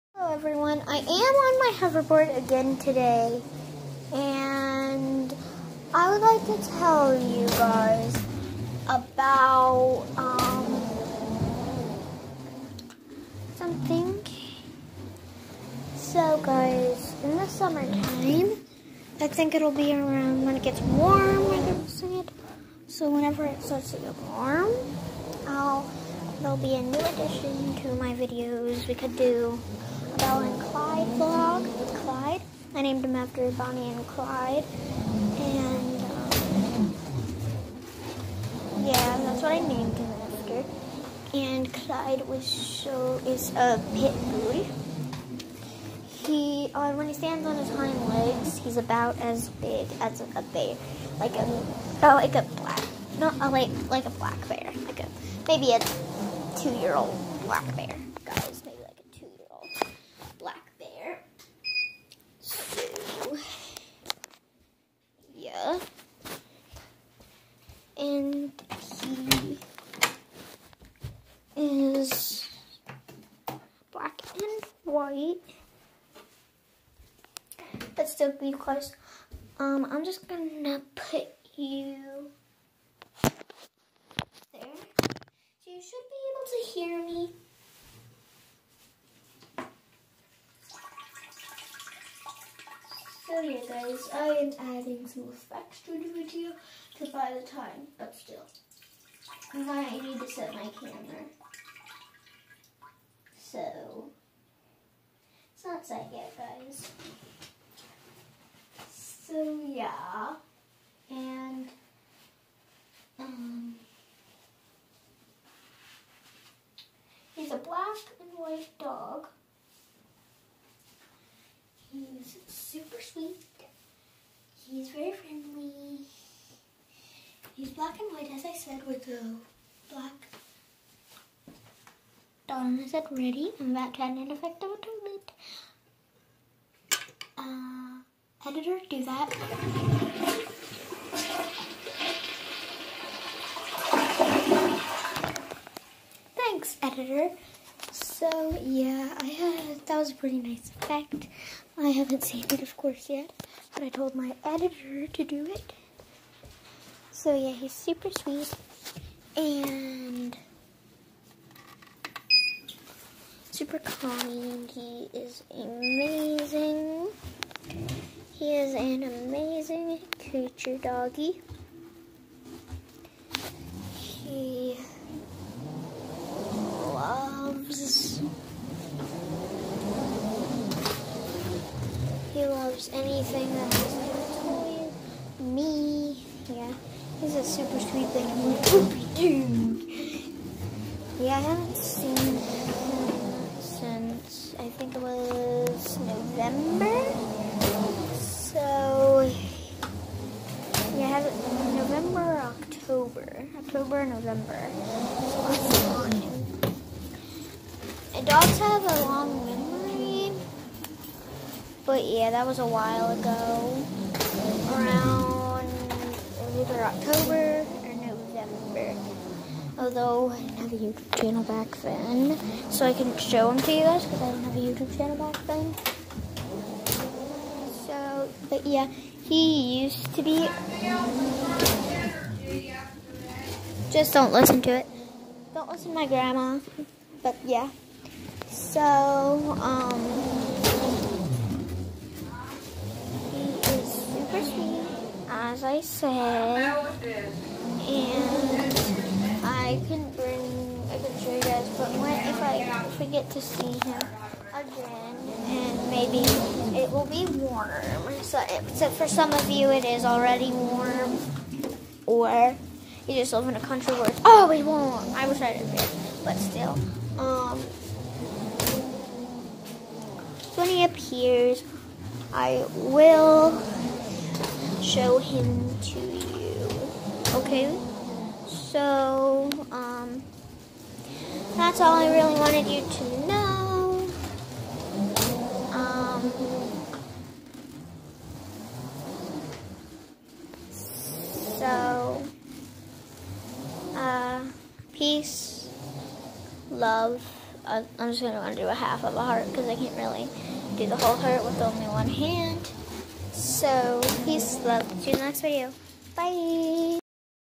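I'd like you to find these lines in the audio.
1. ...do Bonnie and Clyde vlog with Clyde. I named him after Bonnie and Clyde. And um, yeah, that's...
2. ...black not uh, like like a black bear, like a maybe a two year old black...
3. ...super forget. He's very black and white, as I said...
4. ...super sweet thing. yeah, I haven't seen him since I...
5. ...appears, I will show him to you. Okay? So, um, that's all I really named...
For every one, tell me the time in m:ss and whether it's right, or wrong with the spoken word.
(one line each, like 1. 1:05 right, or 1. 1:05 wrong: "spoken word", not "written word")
1. 0:29 right
2. 0:52 right
3. 2:02 wrong: "sweet", not "forget"
4. 3:07 right
5. 4:30 wrong: "wanted", not "named".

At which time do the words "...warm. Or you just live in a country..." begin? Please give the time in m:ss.
4:20.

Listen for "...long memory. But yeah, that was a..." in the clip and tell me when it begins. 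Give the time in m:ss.
3:29.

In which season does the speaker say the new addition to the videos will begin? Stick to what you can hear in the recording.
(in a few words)
Summertime.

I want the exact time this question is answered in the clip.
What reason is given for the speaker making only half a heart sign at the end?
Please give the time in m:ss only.
5:01.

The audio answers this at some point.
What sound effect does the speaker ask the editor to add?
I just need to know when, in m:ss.
2:14.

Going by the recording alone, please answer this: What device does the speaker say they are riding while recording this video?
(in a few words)
Hoverboard.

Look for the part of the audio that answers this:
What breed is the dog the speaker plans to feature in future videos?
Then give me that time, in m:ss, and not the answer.
0:43.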